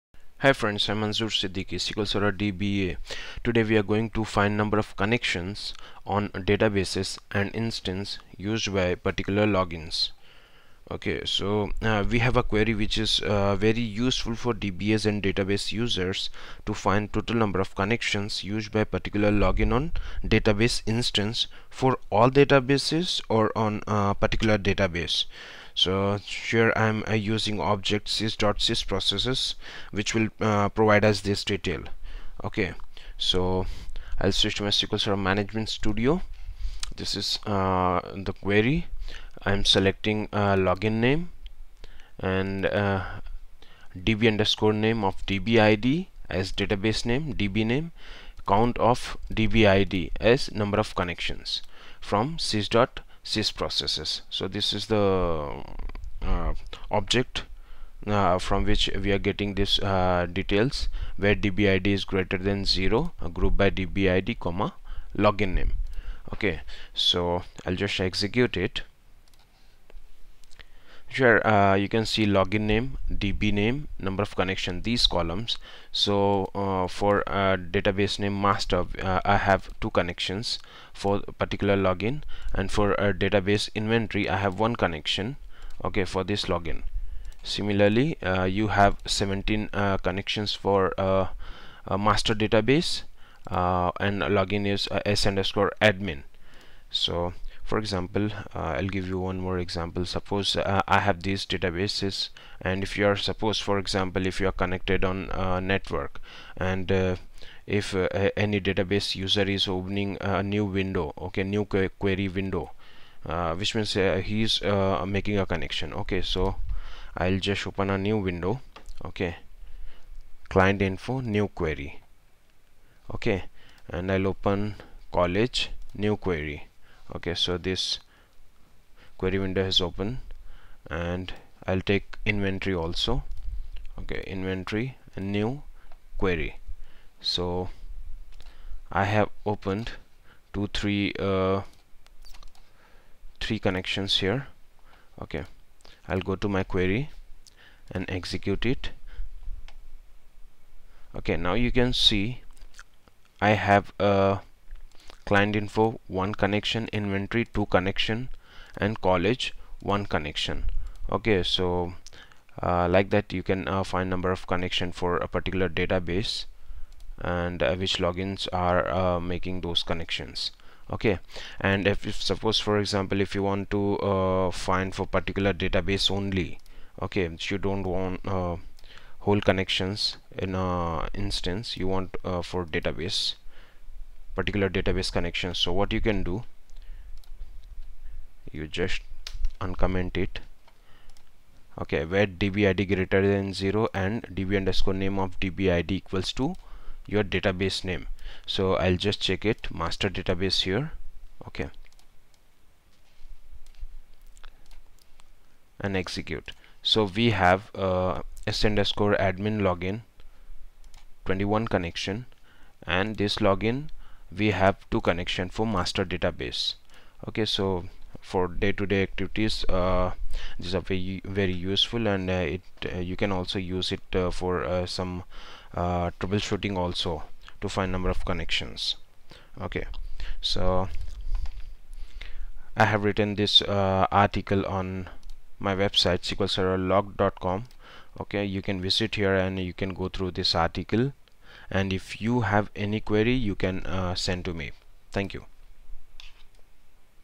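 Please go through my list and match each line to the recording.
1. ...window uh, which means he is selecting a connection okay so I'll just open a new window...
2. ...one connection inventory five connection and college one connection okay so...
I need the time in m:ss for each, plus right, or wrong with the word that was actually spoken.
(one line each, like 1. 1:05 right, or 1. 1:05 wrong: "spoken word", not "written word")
1. 1:52 wrong: "making", not "selecting"
2. 2:36 wrong: "two", not "five".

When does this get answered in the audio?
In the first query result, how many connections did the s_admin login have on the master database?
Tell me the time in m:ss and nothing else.
1:29.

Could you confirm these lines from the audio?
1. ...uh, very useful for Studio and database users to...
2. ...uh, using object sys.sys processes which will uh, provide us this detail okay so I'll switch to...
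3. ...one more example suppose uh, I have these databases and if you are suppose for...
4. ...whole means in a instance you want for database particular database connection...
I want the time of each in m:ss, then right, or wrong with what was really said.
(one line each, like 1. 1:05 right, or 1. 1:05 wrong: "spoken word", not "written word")
1. 0:13 wrong: "DBAs", not "Studio"
2. 0:27 right
3. 1:39 right
4. 2:59 wrong: "connections", not "means".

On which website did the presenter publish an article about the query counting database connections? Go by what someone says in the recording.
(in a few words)
sqlserverlog.com.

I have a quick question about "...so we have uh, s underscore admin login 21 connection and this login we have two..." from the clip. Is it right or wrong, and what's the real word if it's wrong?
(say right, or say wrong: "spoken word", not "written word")
right.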